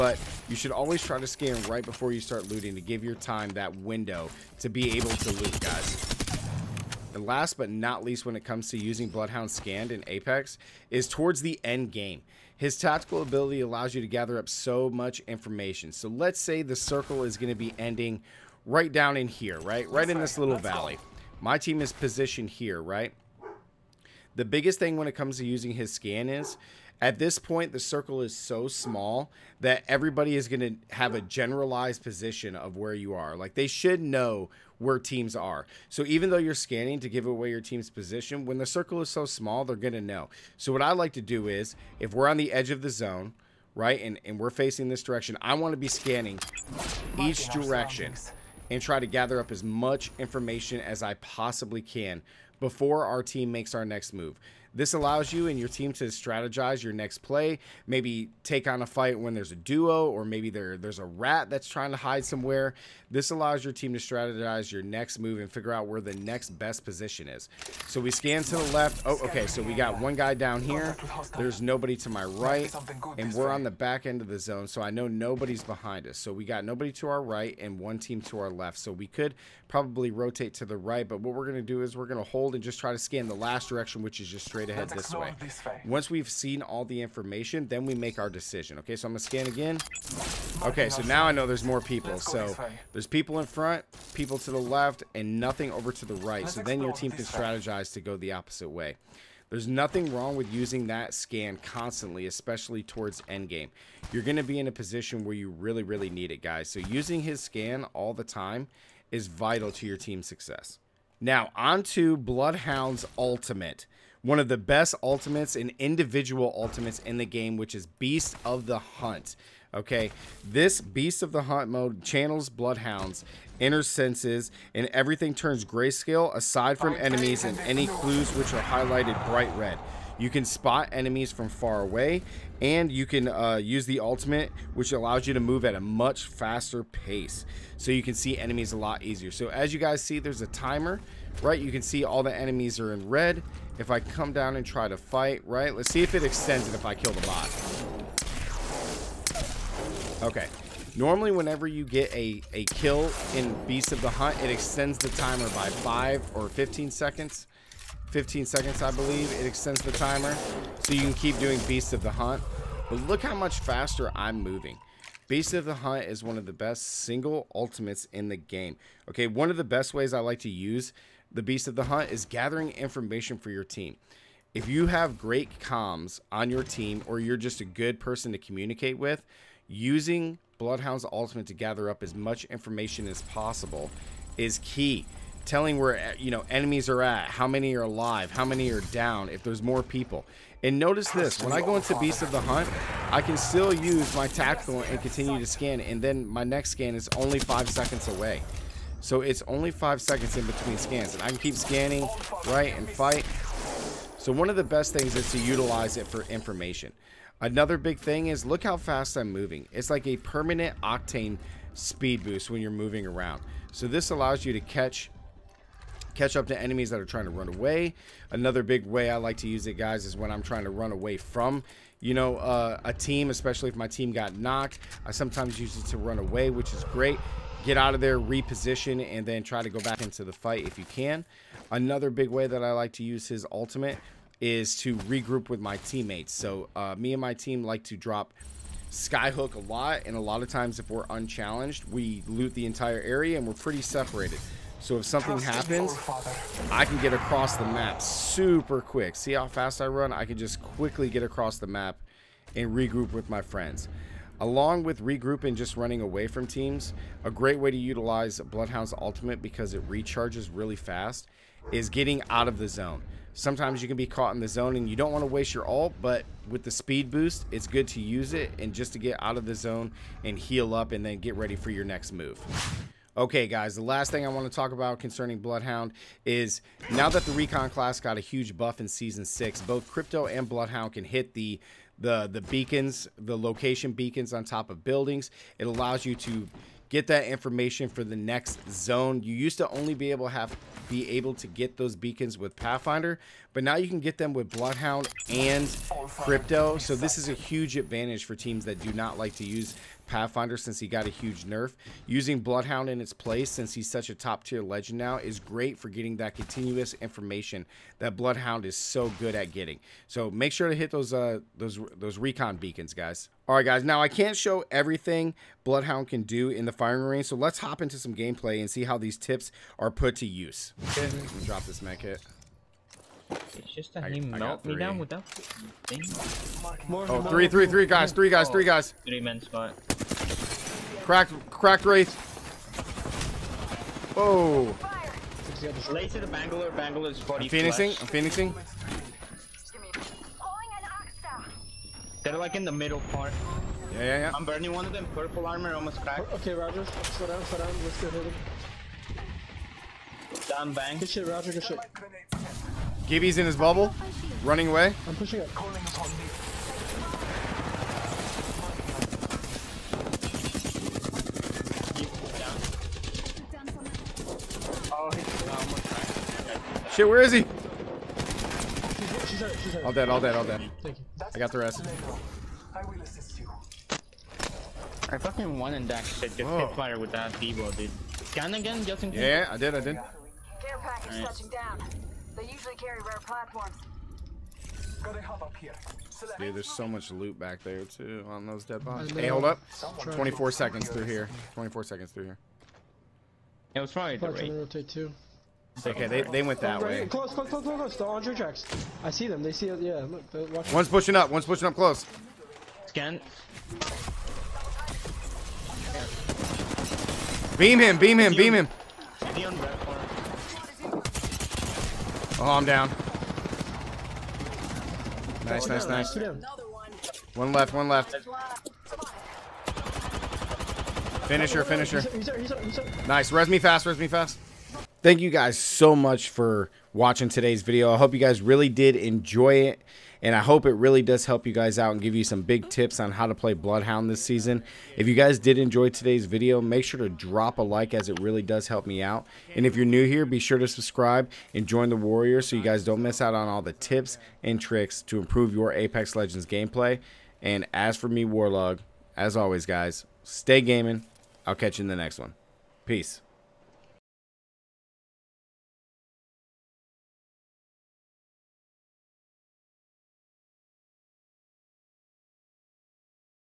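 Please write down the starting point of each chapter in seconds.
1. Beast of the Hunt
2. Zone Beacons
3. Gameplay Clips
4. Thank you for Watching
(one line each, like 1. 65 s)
1. 98 s
2. 272 s
3. 319 s
4. 424 s.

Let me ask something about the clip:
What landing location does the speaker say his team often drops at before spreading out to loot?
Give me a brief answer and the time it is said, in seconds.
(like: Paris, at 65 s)
Skyhook, at 238 s.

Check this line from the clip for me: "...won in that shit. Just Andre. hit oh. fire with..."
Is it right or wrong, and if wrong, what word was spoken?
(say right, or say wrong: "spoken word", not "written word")
wrong: "Whoa", not "Andre".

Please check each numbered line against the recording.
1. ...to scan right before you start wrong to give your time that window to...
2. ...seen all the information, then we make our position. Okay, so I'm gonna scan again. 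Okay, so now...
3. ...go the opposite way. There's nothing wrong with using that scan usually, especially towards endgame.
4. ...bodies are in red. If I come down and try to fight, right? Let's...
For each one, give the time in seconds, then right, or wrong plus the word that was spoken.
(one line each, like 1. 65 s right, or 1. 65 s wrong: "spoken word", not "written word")
1. 1 s wrong: "looting", not "wrong"
2. 86 s wrong: "decision", not "position"
3. 97 s wrong: "constantly", not "usually"
4. 142 s wrong: "enemies", not "bodies".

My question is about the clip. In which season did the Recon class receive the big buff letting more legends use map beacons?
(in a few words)
Season 6.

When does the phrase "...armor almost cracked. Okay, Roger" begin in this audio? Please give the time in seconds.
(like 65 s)
345 s.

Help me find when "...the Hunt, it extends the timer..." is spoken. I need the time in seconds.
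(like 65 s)
154 s.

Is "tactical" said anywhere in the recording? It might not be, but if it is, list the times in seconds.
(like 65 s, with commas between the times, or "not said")
12 s, 194 s.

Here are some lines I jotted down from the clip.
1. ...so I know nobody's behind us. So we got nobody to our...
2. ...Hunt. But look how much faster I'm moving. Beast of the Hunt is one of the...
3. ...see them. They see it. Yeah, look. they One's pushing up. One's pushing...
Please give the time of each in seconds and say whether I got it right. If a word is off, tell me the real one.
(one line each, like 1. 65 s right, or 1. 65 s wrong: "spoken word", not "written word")
1. 74 s right
2. 162 s right
3. 399 s right.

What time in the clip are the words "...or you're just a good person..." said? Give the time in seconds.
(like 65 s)
177 s.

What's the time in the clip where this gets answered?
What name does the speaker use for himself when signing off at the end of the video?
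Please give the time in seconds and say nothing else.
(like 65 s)
448 s.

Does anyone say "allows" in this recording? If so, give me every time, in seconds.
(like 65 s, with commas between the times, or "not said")
13 s, 54 s, 63 s, 134 s, 214 s, 285 s.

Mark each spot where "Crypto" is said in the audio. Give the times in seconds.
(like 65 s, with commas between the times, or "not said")
279 s, 296 s.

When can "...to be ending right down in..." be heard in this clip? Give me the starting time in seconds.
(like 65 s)
17 s.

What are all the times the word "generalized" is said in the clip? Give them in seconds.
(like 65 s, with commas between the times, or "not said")
31 s.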